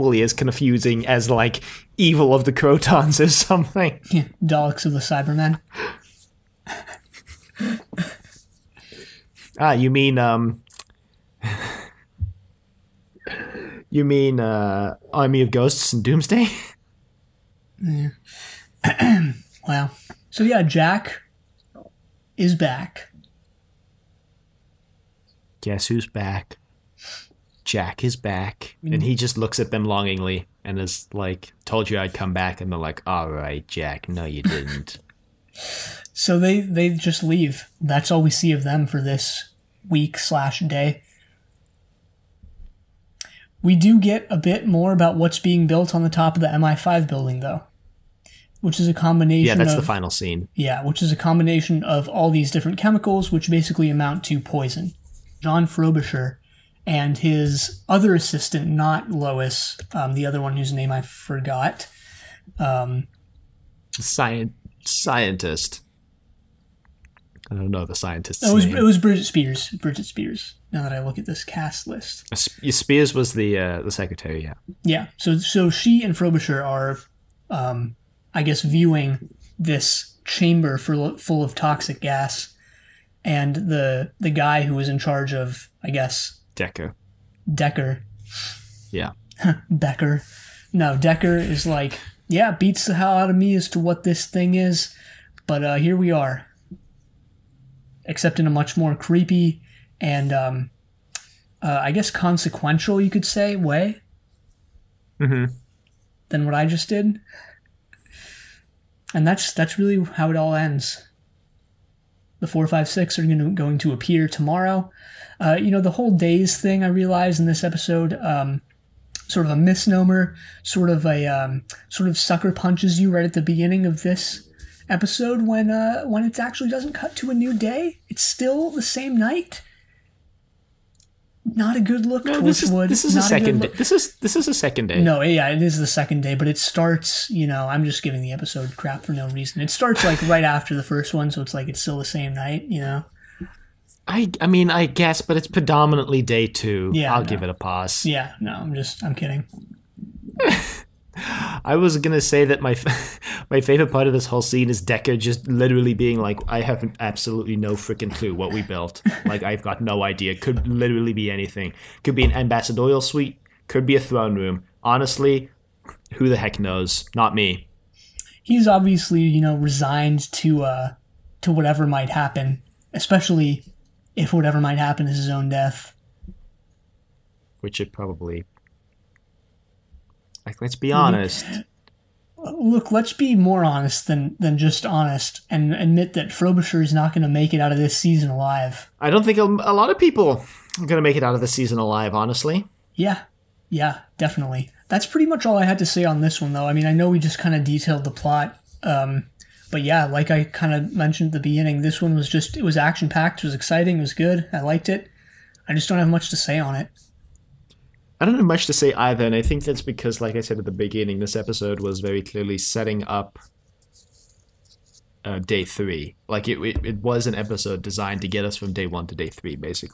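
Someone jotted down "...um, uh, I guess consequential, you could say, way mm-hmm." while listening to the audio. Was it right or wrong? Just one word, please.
right.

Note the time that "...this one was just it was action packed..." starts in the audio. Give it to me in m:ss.
3:21.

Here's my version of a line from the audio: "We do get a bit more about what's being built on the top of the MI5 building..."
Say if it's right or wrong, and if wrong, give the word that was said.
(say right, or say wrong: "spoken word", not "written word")
right.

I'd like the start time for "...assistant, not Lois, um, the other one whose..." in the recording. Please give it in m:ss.
0:58.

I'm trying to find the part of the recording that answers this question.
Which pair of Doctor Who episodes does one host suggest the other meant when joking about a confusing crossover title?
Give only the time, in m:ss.
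0:15.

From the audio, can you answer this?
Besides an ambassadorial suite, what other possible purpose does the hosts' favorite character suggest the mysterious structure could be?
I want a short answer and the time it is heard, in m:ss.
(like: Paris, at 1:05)
A throne room, at 2:43.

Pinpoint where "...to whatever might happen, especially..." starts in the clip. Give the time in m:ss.
2:51.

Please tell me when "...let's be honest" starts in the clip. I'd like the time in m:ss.
3:00.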